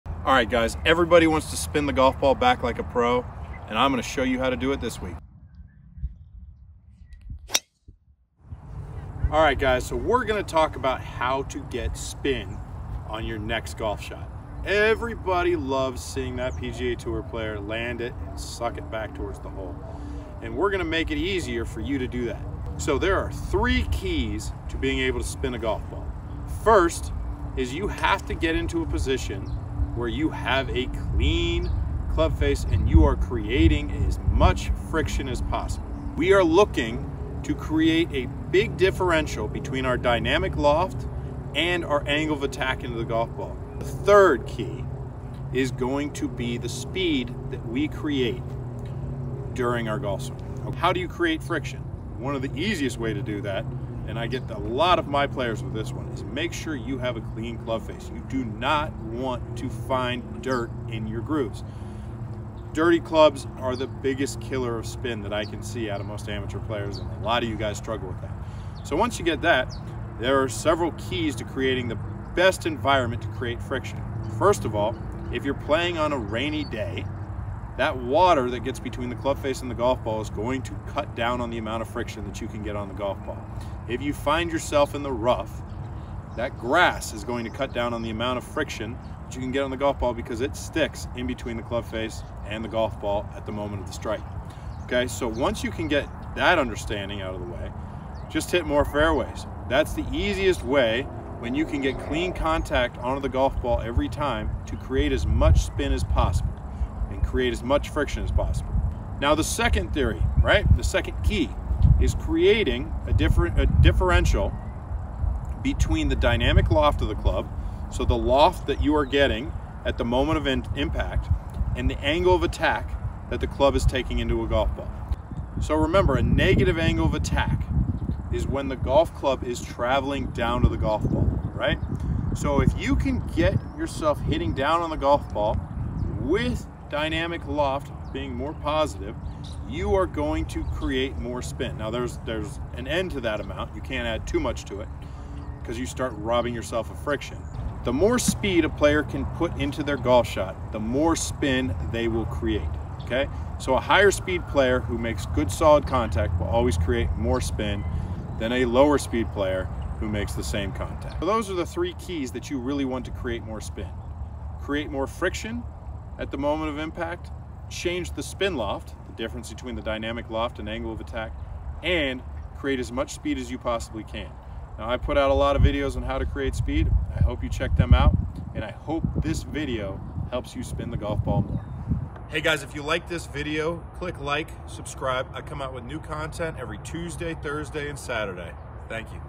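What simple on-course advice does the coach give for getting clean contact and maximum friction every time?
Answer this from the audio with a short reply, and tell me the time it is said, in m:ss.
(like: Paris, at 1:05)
Hit more fairways, at 1:38.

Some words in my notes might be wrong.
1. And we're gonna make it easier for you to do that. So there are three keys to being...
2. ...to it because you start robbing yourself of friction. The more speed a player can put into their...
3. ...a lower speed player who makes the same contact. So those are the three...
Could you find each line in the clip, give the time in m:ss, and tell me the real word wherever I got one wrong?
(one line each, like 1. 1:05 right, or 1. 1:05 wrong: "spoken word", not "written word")
1. 0:20 right
2. 2:24 right
3. 2:38 right.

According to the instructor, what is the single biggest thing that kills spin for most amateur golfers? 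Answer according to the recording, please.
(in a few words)
Dirty clubs.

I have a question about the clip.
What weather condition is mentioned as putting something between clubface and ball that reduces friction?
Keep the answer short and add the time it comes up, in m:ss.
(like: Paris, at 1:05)
Rainy day, at 1:16.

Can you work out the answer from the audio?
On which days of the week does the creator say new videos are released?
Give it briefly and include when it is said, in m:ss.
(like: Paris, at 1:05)
Tuesday, Thursday, and Saturday, at 3:06.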